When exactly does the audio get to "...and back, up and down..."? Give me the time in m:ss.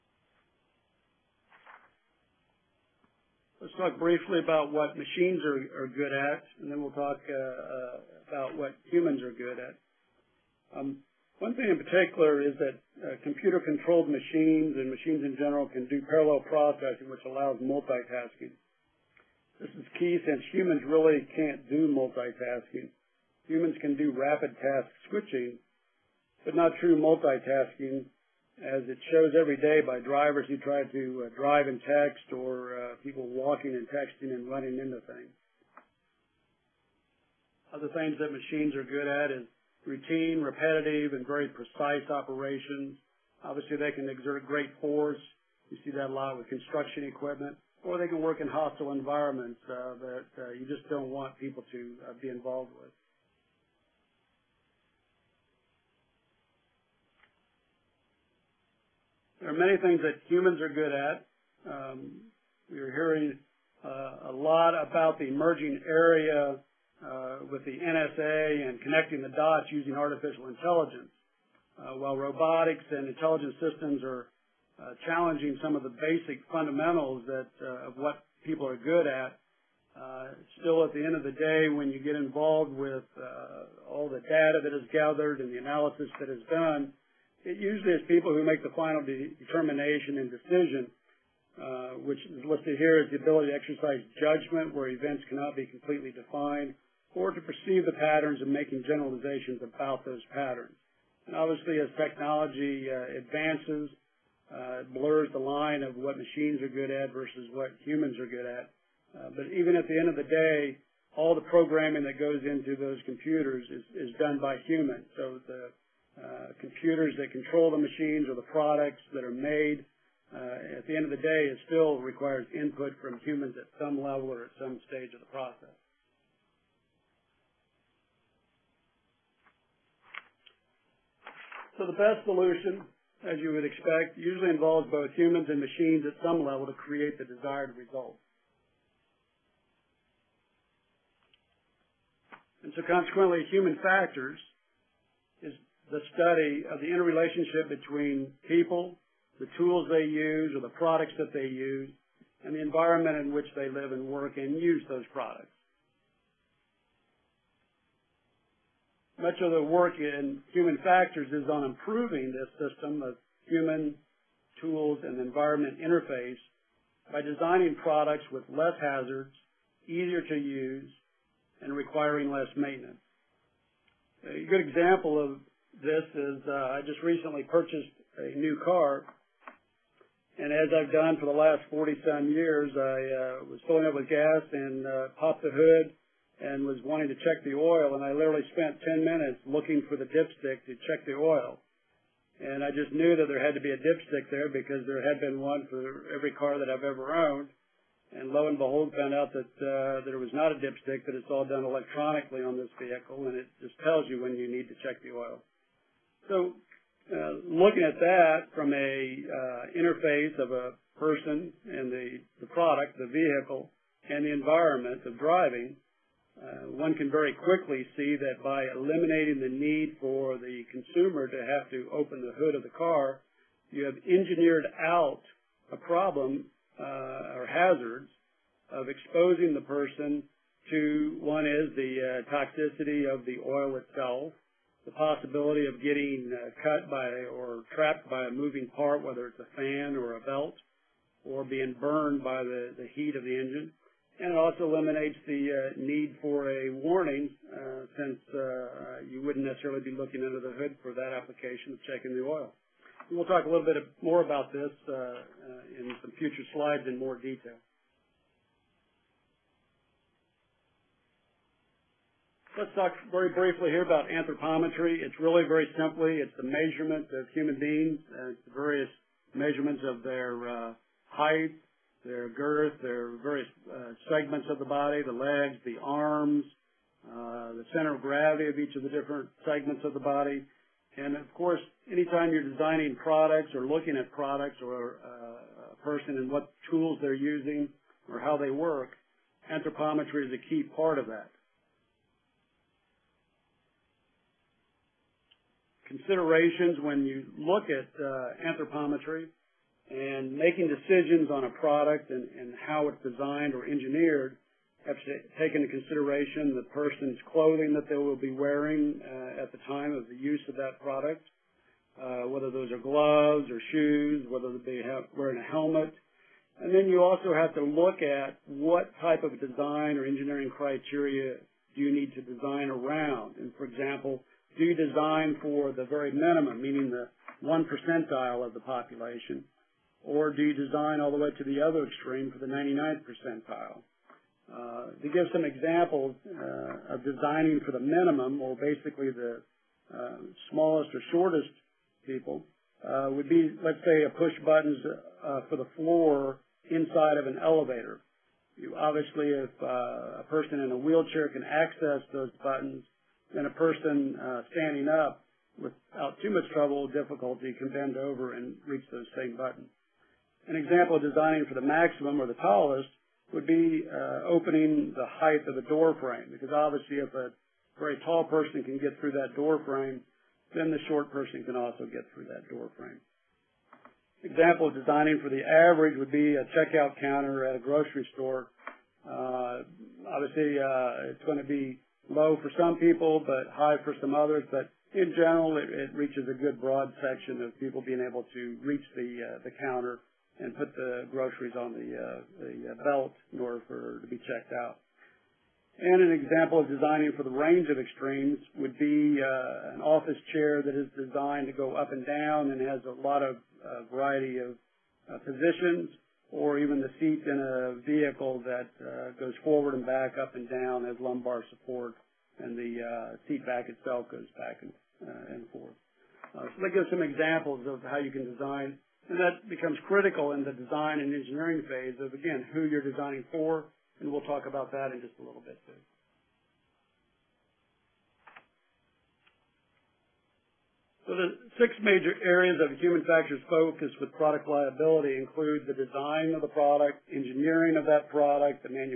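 6:49.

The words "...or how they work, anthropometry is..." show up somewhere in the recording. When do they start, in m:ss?
4:48.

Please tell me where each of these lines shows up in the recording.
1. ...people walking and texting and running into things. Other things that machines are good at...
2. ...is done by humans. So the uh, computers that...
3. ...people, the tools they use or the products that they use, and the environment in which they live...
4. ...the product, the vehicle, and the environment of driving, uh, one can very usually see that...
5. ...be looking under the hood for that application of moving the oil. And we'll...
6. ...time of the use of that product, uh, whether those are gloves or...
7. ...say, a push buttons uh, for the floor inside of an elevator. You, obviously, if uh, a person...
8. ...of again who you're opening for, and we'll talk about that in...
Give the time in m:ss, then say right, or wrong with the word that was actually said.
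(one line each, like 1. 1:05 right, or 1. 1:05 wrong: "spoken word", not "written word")
1. 0:33 right
2. 1:54 right
3. 2:28 right
4. 3:32 wrong: "quickly", not "usually"
5. 4:09 wrong: "checking", not "moving"
6. 5:09 right
7. 5:43 right
8. 7:01 wrong: "designing", not "opening".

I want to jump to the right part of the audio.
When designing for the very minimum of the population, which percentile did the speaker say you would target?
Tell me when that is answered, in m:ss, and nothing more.
5:27.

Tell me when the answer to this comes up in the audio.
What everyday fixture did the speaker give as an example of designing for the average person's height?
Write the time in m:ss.
6:16.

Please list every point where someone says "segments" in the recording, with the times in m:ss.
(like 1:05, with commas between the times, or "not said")
4:34, 4:39.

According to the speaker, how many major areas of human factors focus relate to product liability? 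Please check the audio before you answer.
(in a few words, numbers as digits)
6.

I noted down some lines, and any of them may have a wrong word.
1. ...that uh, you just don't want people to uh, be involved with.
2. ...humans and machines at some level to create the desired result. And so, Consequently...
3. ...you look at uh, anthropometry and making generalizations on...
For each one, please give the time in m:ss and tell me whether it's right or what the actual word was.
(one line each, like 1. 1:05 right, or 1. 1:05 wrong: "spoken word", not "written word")
1. 0:50 right
2. 2:15 right
3. 4:57 wrong: "decisions", not "generalizations".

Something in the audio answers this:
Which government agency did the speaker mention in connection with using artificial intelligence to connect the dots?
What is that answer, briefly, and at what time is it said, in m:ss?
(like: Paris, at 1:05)
NSA, at 1:07.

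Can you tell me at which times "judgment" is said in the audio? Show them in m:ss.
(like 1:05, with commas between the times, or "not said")
1:34.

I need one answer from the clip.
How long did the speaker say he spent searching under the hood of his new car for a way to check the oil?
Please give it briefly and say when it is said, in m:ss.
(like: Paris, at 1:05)
10 minutes, at 3:08.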